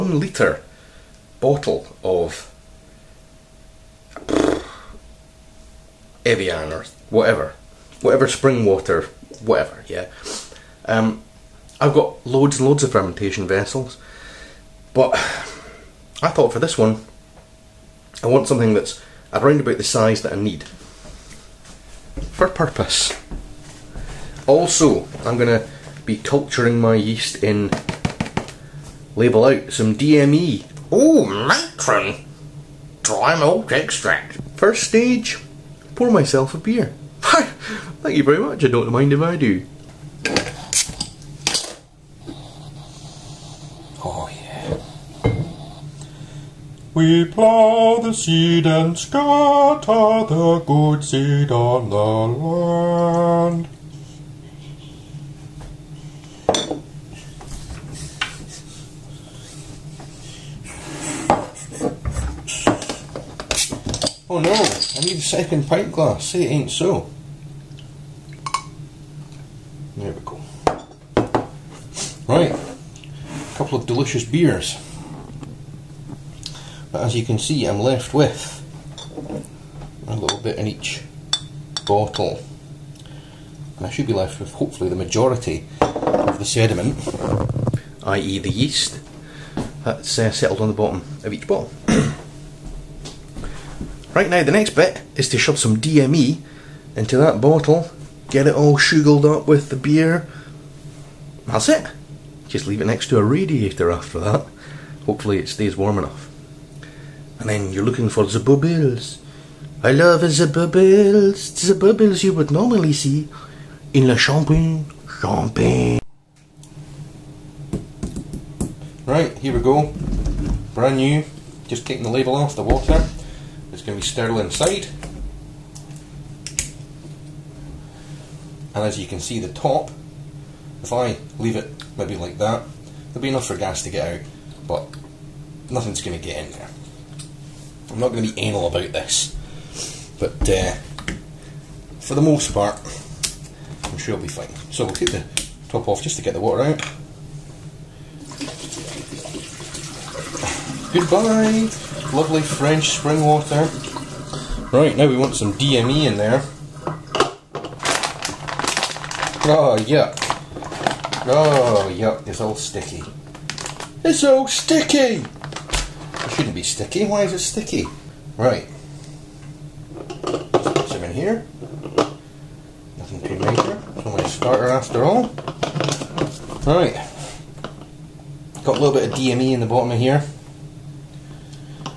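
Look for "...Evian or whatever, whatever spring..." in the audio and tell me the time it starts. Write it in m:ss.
0:06.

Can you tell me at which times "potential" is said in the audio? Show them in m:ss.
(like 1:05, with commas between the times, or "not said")
not said.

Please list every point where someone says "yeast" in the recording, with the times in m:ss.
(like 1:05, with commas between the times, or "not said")
0:26, 1:28.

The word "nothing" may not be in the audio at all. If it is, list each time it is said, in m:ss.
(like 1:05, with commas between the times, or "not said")
2:15, 2:52.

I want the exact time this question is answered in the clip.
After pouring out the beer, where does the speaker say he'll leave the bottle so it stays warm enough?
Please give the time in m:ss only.
1:42.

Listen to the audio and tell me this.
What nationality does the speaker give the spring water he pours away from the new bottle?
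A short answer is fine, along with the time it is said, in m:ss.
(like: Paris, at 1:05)
French, at 2:32.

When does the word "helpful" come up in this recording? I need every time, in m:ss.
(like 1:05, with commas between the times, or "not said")
not said.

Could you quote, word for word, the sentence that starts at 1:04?
Oh no, I need a second pint glass, say it ain't so.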